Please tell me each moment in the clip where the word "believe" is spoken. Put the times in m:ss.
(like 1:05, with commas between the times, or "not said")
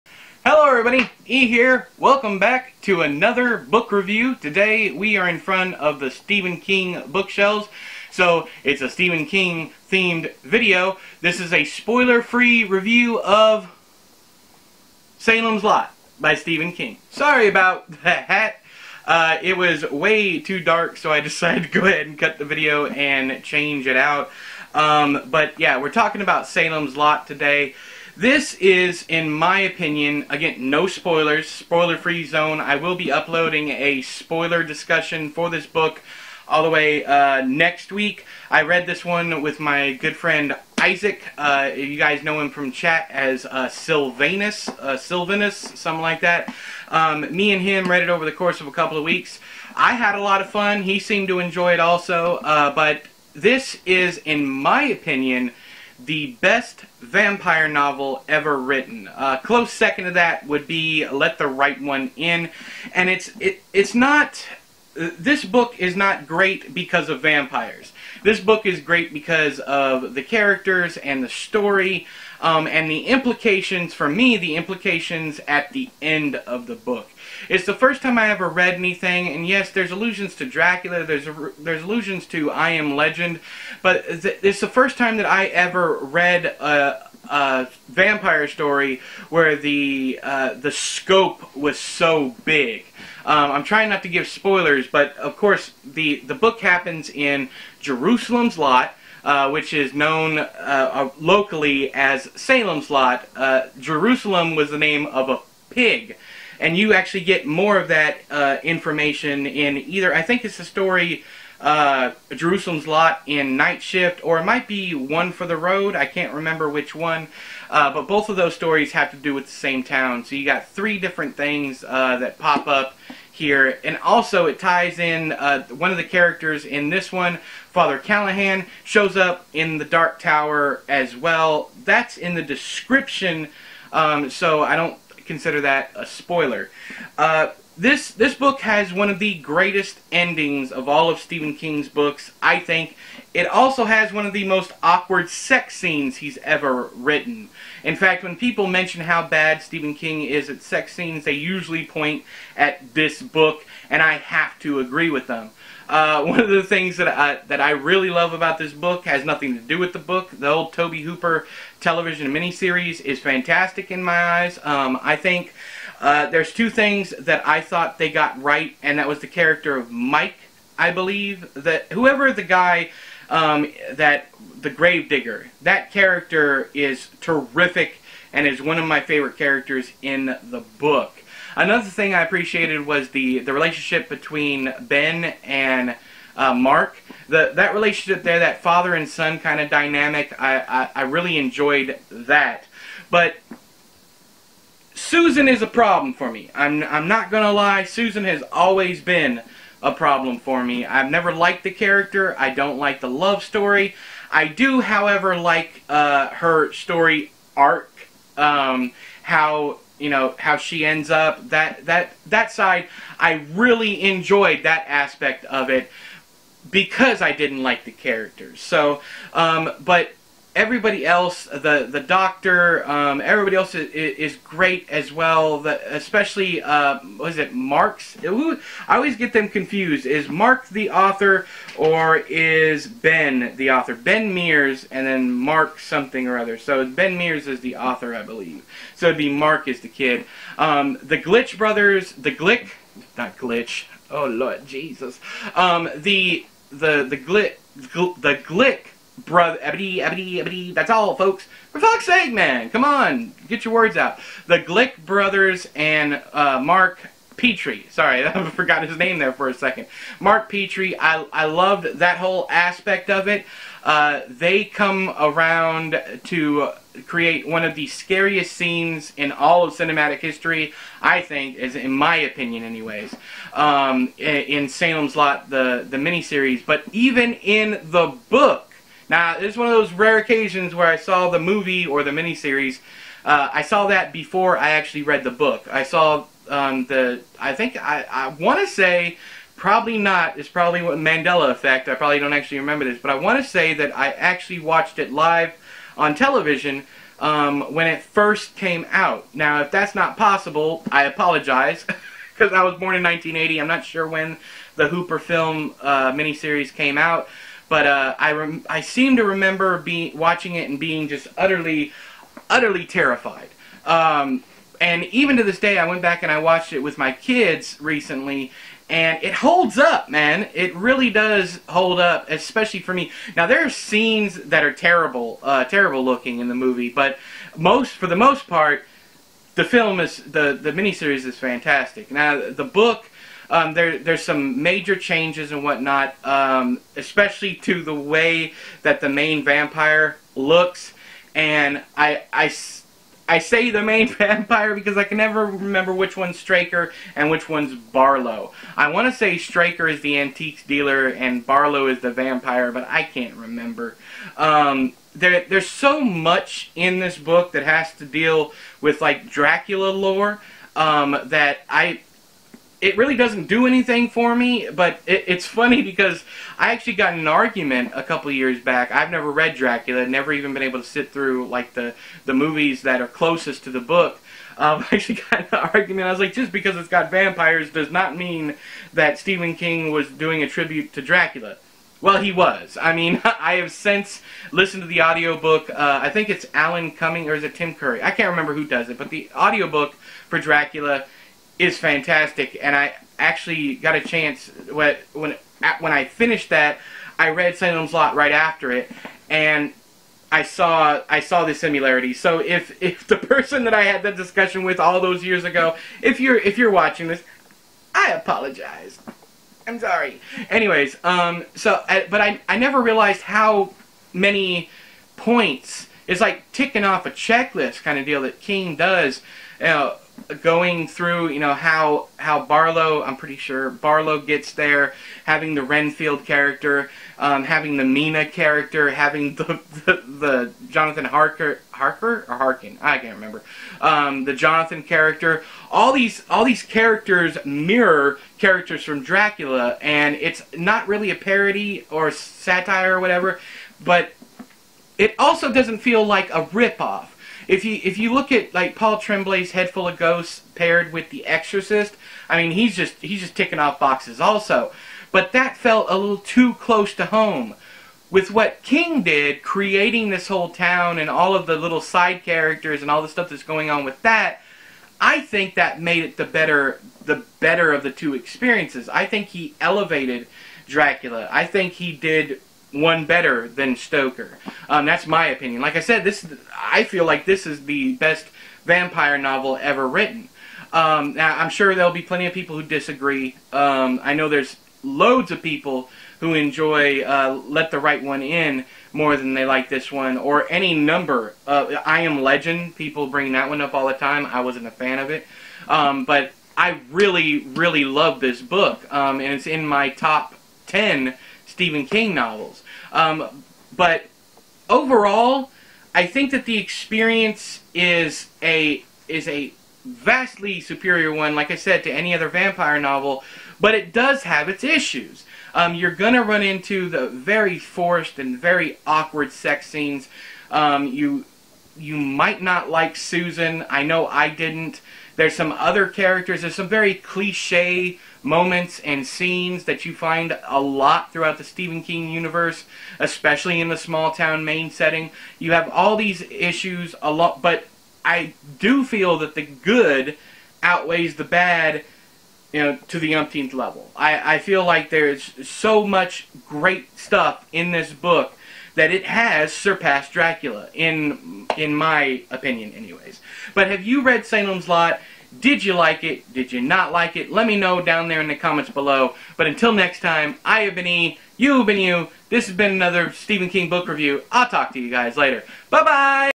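2:50, 3:58.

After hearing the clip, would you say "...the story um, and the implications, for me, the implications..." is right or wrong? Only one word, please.
right.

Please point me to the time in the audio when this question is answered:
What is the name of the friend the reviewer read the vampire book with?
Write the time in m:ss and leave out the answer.
0:40.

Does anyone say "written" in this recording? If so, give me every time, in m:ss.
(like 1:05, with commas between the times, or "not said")
0:58, 2:26, 7:59.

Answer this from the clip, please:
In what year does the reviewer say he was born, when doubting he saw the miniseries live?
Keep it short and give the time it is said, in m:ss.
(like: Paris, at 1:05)
1980, at 5:03.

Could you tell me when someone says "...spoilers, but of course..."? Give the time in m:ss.
1:34.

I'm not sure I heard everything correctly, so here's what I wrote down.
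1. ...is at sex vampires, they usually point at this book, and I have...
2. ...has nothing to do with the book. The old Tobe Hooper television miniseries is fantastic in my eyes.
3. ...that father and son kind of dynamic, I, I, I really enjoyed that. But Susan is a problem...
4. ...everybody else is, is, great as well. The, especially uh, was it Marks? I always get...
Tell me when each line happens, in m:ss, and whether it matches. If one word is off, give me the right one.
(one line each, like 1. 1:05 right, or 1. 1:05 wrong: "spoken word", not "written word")
1. 2:30 wrong: "scenes", not "vampires"
2. 2:39 right
3. 3:08 right
4. 3:43 right.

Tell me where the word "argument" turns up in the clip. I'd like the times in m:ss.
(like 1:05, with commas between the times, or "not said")
6:07, 6:15.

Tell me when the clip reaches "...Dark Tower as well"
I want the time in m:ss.
2:09.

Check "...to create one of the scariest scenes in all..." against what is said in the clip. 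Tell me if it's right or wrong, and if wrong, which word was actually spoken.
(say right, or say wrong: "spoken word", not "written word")
right.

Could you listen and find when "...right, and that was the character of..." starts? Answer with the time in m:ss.
2:48.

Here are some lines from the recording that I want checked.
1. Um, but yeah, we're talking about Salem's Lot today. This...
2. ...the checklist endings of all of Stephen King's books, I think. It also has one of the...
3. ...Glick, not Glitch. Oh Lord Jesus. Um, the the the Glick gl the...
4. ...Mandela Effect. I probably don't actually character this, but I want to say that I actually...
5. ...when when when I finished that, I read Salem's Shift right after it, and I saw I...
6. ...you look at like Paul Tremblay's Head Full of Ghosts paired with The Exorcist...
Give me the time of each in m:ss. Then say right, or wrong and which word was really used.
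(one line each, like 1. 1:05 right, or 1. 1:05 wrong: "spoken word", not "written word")
1. 0:24 right
2. 2:19 wrong: "greatest", not "checklist"
3. 4:02 right
4. 4:50 wrong: "remember", not "character"
5. 6:34 wrong: "Lot", not "Shift"
6. 7:27 right.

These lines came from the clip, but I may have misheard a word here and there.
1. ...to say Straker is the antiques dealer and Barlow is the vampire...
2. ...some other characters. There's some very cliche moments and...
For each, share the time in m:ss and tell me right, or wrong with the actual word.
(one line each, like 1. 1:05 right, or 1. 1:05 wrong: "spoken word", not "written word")
1. 5:49 right
2. 8:45 right.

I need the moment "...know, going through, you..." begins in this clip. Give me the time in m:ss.
6:59.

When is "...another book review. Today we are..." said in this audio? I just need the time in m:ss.
0:03.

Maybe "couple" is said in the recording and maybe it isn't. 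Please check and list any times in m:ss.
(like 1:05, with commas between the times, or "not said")
0:48, 6:08.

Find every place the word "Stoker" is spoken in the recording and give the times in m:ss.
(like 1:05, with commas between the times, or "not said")
7:53.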